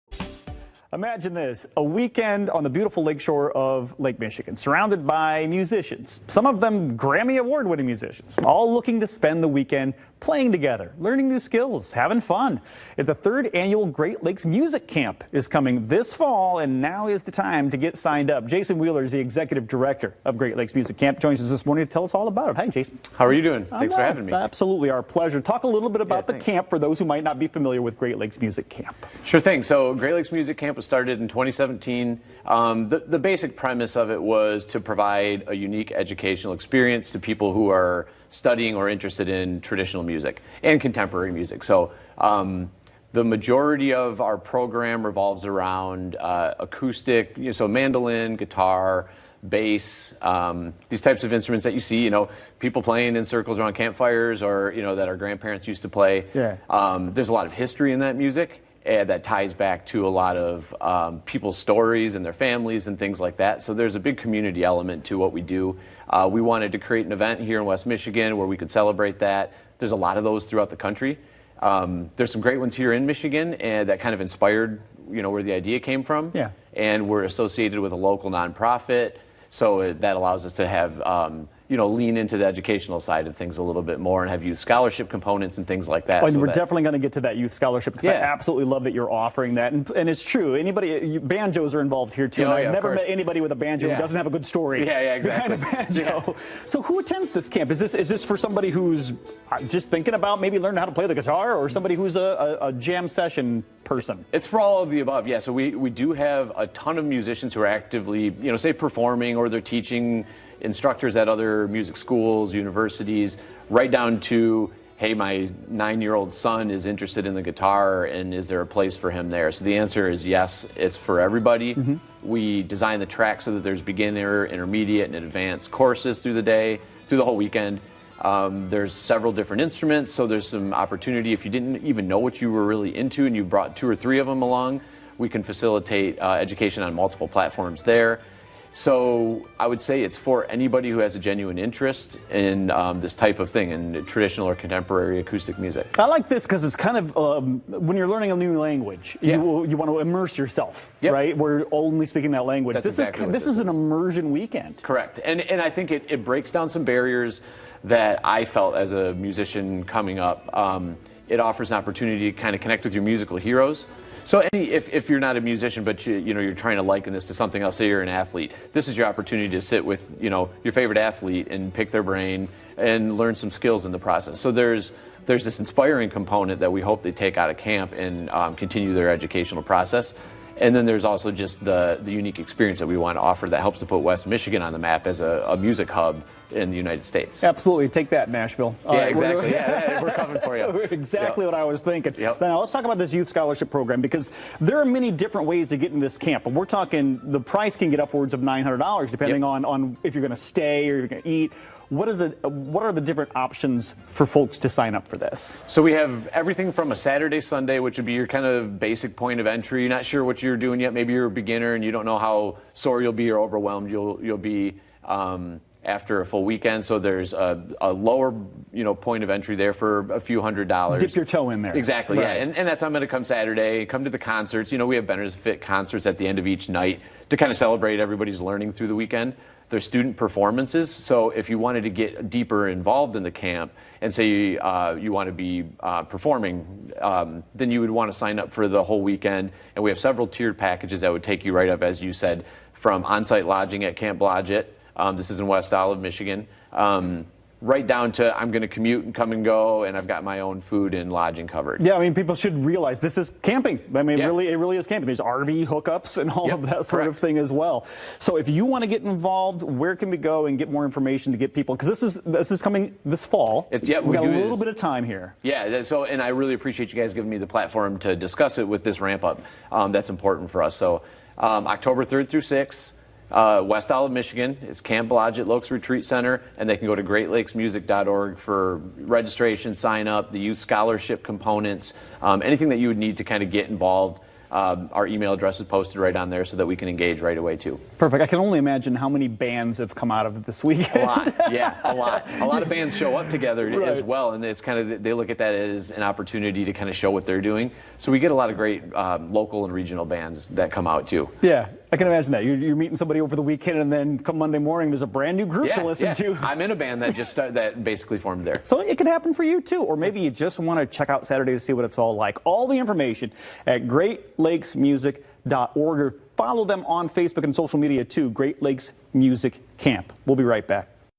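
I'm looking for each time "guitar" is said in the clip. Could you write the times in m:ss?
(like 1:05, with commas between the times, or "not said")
0:48, 1:41, 1:57.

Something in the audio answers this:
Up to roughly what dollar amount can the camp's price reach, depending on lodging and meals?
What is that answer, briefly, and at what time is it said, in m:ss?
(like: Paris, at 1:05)
$900, at 3:18.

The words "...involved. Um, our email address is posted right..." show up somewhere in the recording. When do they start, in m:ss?
4:43.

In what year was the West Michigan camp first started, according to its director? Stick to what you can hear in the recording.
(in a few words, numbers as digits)
2017.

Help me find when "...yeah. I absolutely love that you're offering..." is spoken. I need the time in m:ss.
1:28.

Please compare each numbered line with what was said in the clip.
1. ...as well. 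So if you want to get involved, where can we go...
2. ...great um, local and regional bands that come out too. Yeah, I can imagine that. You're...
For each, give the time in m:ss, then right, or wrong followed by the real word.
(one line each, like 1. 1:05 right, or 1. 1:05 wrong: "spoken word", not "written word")
1. 4:17 right
2. 4:58 right.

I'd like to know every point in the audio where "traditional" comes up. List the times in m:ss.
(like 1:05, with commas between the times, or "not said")
0:39, 2:24.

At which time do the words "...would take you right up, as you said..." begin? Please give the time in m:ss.
4:01.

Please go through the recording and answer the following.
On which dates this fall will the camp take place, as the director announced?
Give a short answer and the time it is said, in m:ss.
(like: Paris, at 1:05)
October 3rd through 6th, at 4:31.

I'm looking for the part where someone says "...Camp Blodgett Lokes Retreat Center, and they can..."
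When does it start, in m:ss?
4:34.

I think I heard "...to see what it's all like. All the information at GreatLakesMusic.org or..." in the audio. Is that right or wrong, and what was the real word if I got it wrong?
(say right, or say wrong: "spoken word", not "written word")
right.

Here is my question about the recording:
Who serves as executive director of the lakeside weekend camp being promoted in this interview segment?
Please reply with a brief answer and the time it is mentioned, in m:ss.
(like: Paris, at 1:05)
Jason Wheeler, at 0:18.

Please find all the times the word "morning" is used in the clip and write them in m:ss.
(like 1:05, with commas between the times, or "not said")
0:21, 5:04.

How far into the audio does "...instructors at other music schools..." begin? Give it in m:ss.
1:50.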